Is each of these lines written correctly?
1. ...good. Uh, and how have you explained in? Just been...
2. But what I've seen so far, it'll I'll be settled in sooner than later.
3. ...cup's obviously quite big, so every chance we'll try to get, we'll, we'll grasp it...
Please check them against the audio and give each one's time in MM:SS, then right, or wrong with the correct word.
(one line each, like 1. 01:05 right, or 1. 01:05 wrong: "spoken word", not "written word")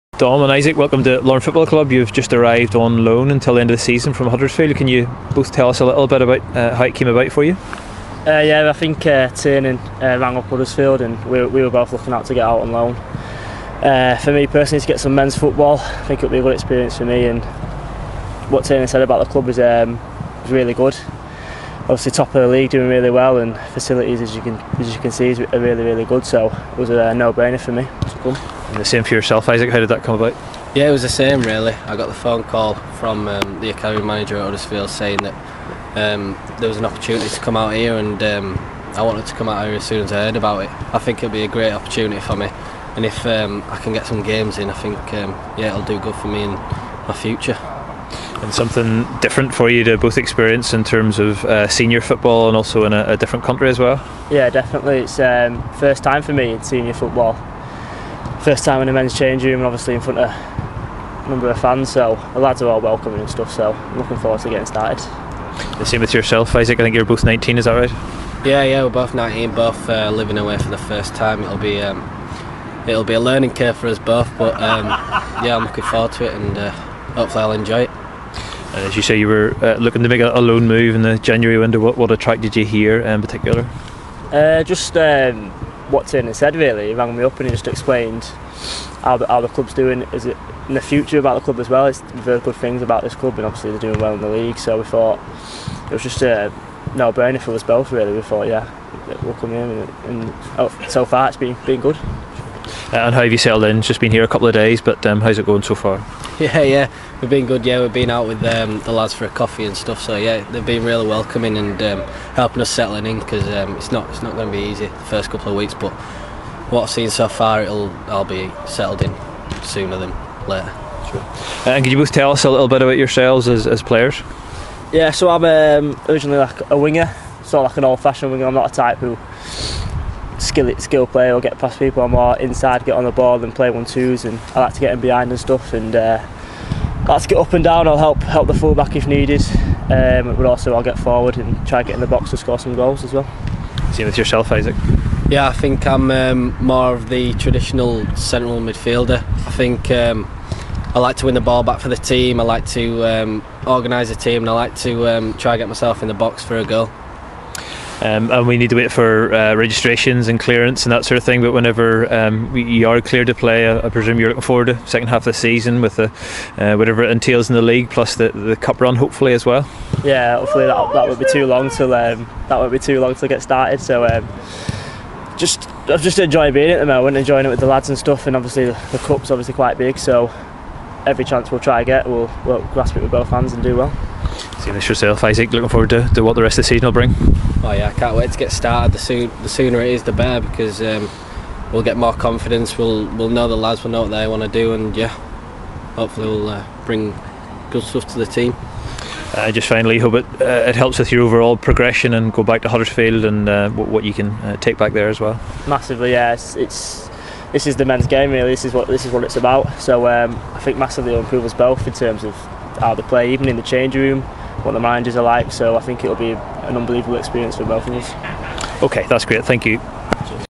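1. 01:41 wrong: "settled", not "explained"
2. 01:55 right
3. 02:58 right.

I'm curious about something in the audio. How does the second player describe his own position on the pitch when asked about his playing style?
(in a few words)
Traditional central midfielder.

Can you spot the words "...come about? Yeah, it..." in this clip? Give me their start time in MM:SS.
00:30.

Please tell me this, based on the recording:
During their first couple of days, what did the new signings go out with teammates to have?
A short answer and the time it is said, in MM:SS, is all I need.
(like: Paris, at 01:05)
Coffee, at 01:49.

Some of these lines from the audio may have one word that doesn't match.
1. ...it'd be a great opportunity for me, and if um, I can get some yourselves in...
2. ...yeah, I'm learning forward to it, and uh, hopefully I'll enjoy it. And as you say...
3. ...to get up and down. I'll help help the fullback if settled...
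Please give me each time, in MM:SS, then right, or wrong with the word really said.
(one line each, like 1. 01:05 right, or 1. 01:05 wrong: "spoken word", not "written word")
1. 00:41 wrong: "games", not "yourselves"
2. 01:15 wrong: "looking", not "learning"
3. 02:17 wrong: "needed", not "settled".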